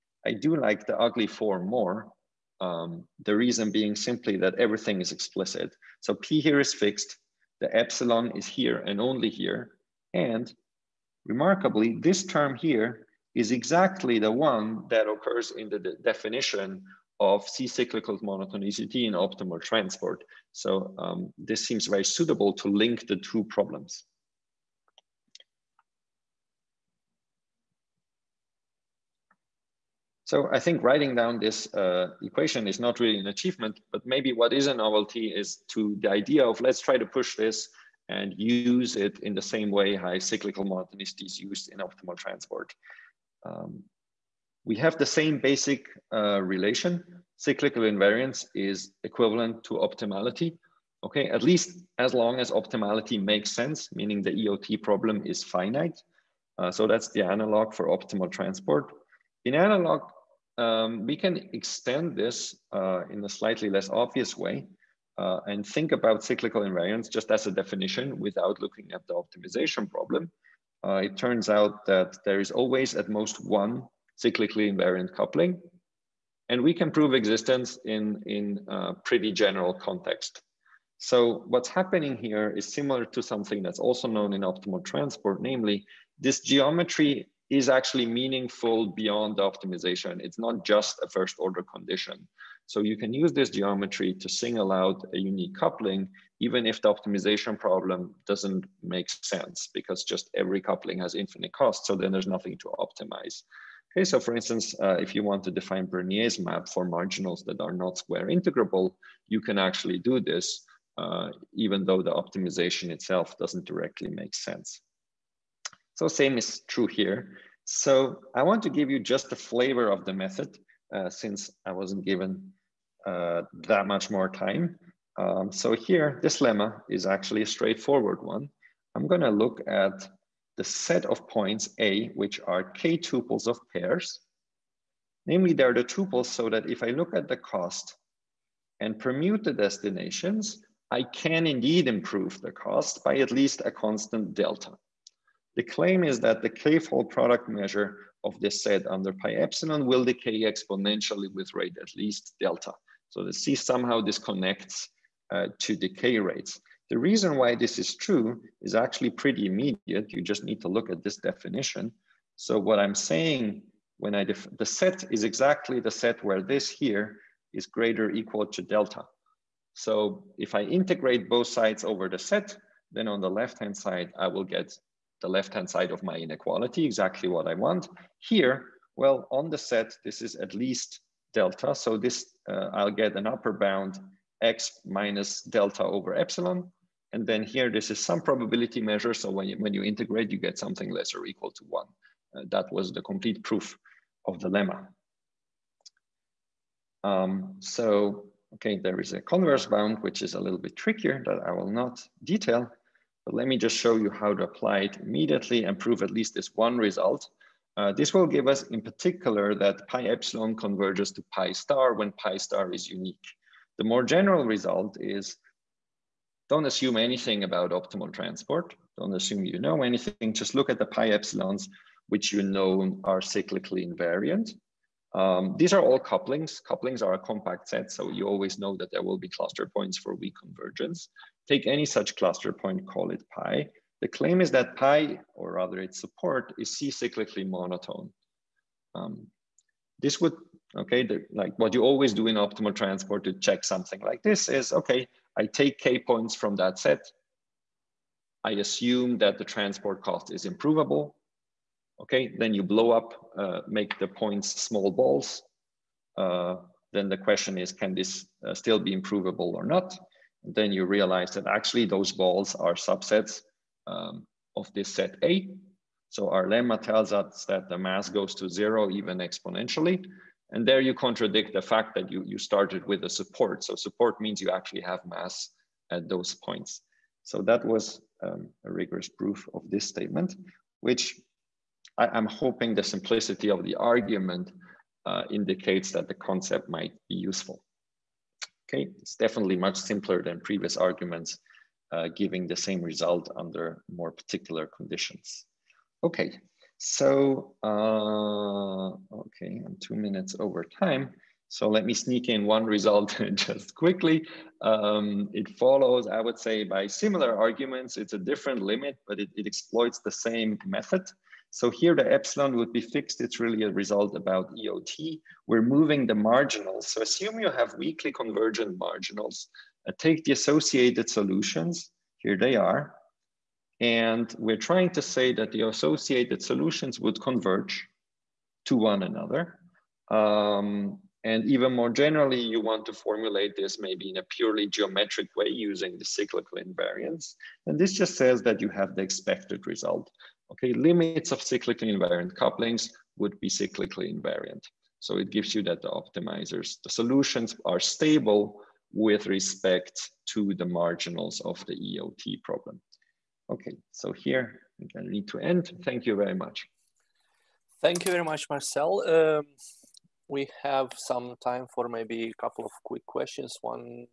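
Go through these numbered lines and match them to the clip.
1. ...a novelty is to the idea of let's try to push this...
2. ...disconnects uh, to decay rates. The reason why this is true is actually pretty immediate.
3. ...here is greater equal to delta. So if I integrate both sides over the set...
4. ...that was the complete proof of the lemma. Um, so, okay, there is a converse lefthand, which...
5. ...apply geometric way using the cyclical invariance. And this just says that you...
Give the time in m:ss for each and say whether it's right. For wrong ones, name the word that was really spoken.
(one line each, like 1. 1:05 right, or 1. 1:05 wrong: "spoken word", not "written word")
1. 0:34 right
2. 2:33 right
3. 2:46 right
4. 3:12 wrong: "bound", not "lefthand"
5. 5:34 wrong: "purely", not "apply".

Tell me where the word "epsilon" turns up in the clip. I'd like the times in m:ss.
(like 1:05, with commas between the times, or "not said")
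0:07, 2:29, 3:06, 3:30, 3:41, 5:12.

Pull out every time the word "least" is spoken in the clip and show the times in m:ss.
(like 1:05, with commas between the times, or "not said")
0:51, 2:23, 2:31, 3:00, 3:26.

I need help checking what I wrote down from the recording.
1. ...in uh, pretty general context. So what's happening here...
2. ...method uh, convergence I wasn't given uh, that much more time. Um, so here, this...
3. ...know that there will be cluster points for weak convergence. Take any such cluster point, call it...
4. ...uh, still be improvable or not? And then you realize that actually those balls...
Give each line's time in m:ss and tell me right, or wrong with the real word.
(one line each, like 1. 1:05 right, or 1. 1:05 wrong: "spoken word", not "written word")
1. 1:18 right
2. 2:00 wrong: "since", not "convergence"
3. 3:48 right
4. 4:18 right.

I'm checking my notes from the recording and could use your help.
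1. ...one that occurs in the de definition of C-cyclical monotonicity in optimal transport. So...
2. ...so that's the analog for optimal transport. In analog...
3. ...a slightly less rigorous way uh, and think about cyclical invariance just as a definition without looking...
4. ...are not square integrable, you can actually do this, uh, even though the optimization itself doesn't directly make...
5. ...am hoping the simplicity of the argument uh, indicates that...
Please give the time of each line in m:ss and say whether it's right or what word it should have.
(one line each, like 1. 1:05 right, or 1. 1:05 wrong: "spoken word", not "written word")
1. 0:14 right
2. 0:56 right
3. 1:03 wrong: "obvious", not "rigorous"
4. 1:47 right
5. 4:42 right.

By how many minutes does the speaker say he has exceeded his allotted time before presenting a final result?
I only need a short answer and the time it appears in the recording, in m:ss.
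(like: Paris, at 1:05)
2, at 4:59.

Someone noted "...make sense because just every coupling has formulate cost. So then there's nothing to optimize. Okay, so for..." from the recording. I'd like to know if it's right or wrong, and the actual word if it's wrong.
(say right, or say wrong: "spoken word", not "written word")
wrong: "infinite", not "formulate".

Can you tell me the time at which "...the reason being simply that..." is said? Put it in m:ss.
0:03.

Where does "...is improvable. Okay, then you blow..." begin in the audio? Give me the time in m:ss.
4:10.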